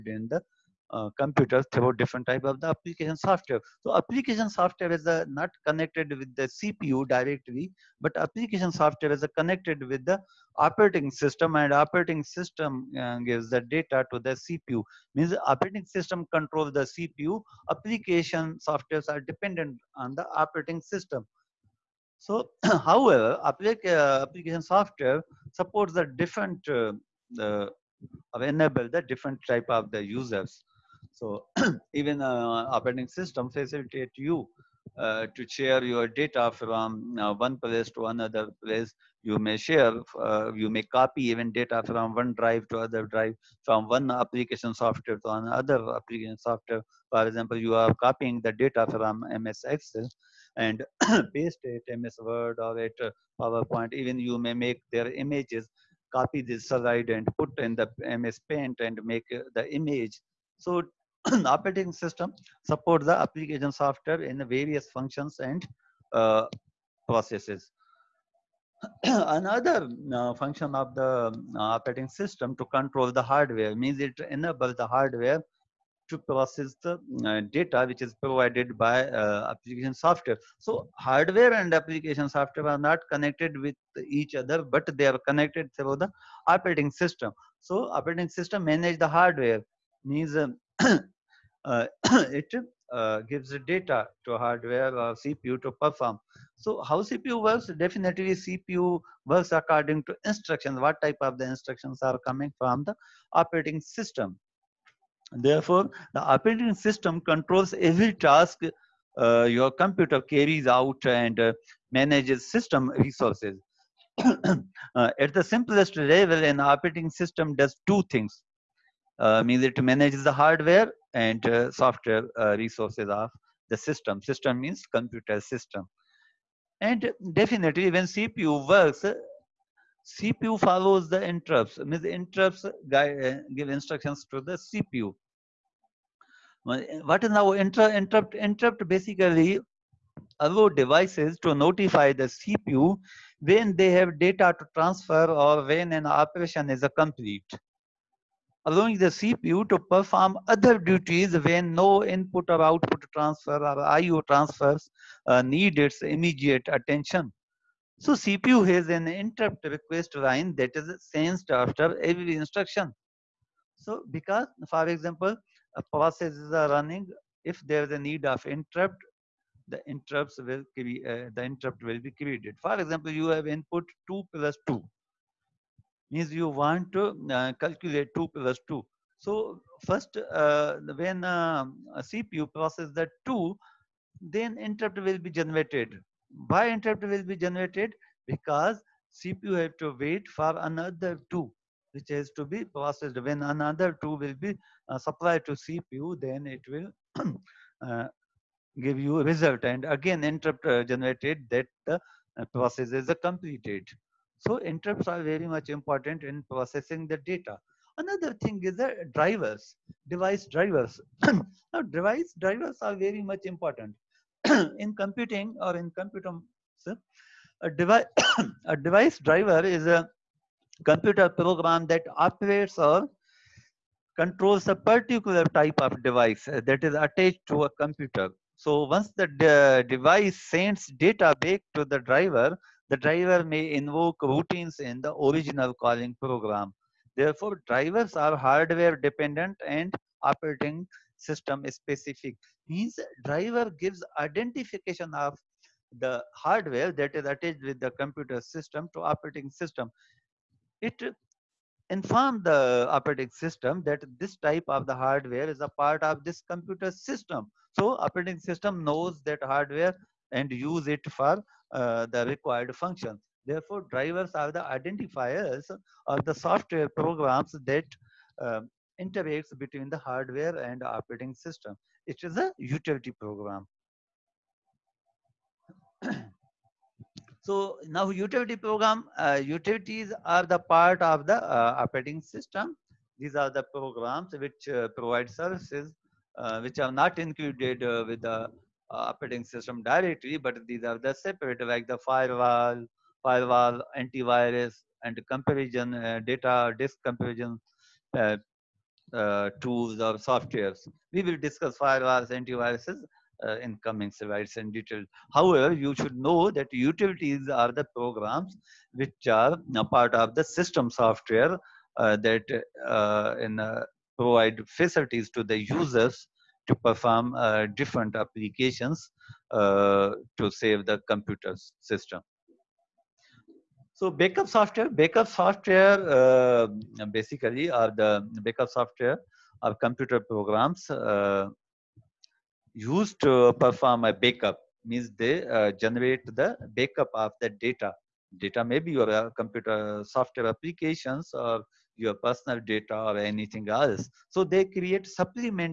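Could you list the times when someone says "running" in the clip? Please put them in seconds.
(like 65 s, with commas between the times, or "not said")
166 s.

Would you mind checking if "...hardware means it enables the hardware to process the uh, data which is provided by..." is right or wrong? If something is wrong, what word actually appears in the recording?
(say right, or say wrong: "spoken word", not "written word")
right.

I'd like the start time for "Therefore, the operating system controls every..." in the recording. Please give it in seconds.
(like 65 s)
105 s.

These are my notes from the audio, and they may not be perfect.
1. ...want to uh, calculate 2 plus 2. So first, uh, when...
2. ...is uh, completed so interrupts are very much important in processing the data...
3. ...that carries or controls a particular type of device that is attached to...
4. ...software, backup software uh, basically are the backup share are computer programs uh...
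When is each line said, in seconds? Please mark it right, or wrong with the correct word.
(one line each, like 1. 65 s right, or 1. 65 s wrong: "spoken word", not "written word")
1. 176 s right
2. 202 s right
3. 221 s wrong: "operates", not "carries"
4. 324 s wrong: "software", not "share".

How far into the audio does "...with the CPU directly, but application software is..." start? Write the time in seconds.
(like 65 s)
6 s.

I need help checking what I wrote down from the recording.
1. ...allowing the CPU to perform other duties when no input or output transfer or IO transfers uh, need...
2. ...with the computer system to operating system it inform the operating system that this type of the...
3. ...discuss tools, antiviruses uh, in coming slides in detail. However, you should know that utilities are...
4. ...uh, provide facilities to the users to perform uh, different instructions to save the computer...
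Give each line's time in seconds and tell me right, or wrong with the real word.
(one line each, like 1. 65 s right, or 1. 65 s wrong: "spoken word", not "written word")
1. 148 s right
2. 247 s right
3. 301 s wrong: "firewalls", not "tools"
4. 313 s wrong: "applications", not "instructions".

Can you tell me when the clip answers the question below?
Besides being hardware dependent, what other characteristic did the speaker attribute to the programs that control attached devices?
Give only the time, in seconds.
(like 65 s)
240 s.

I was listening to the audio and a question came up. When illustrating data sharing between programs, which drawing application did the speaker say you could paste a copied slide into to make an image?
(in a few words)
MS Paint.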